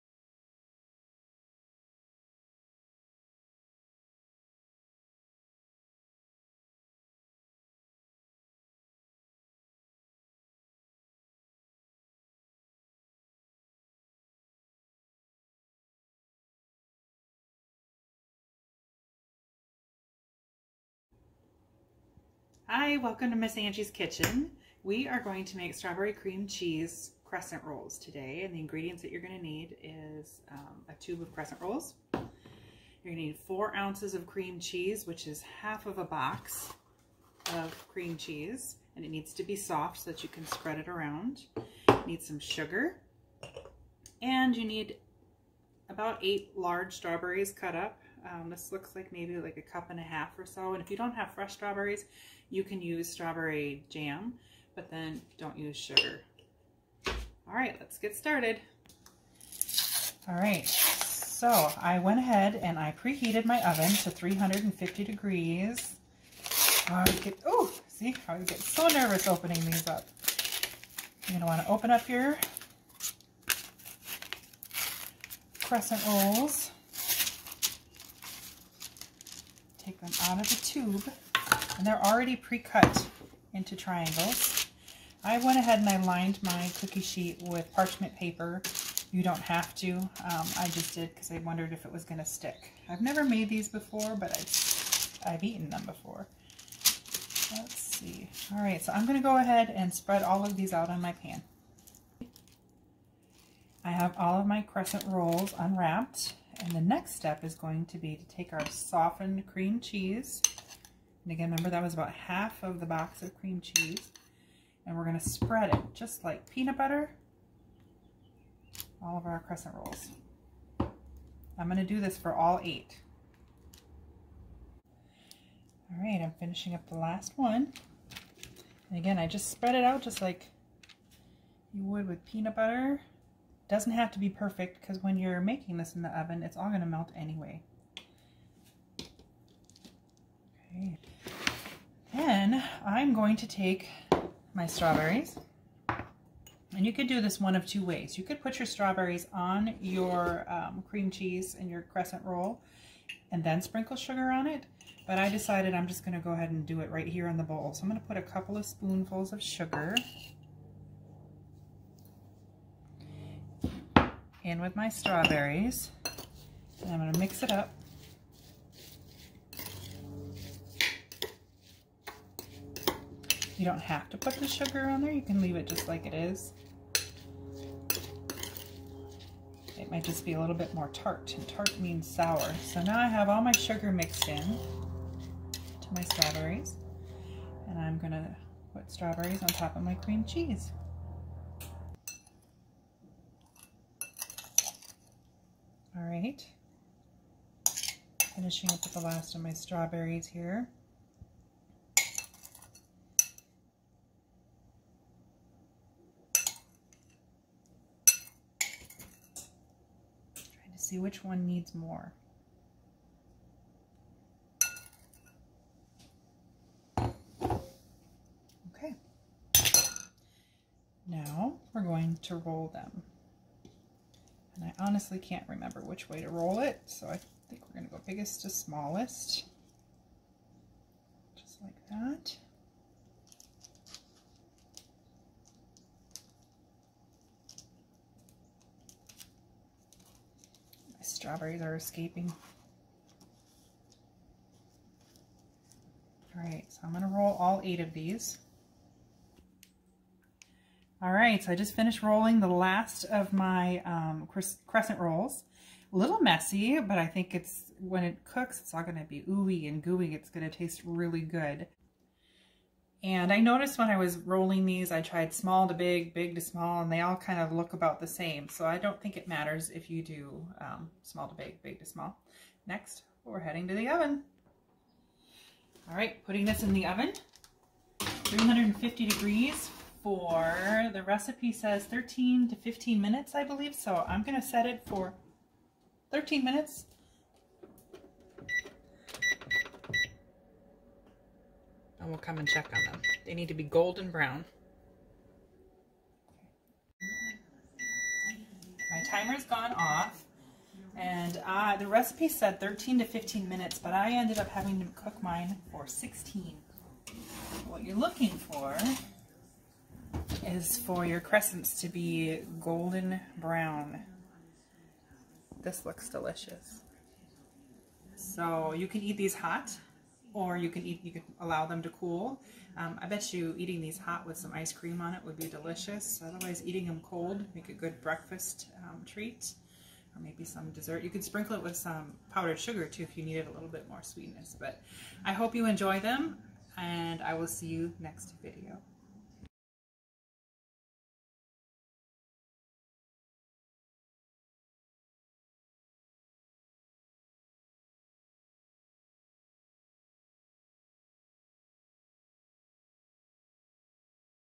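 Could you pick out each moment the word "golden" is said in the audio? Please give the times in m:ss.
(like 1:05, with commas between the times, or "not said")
4:53, 5:12.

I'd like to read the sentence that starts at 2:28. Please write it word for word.
You could put your strawberries on your um, cream cheese and your crescent roll and then sprinkle sugar on it.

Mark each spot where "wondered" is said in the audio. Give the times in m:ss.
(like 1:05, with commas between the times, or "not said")
1:31.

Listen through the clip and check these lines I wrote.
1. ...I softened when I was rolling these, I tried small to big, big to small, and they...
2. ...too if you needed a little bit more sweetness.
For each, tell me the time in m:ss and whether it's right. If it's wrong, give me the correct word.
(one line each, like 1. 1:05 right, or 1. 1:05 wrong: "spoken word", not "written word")
1. 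4:23 wrong: "noticed", not "softened"
2. 5:32 right.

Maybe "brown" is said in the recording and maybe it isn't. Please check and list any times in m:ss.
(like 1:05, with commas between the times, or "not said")
4:54, 5:13.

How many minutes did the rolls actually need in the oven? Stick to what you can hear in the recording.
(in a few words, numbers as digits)
16.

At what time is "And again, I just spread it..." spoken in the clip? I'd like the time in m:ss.
2:08.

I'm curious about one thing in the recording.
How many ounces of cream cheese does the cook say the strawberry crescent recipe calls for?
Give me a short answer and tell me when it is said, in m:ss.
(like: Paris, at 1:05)
4 ounces, at 0:33.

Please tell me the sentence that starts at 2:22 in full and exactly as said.
Then I'm going to take my strawberries.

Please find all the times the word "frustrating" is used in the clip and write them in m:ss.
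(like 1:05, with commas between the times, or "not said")
not said.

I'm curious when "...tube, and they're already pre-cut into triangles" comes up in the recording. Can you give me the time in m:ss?
1:20.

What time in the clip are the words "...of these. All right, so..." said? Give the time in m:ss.
4:07.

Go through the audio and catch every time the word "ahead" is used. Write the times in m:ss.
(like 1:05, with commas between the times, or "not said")
1:02, 1:25, 1:39, 2:36.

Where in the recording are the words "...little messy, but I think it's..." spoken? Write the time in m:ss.
4:15.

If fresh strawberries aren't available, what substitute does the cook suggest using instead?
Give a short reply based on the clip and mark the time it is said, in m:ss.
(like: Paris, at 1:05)
strawberry jam, at 0:53.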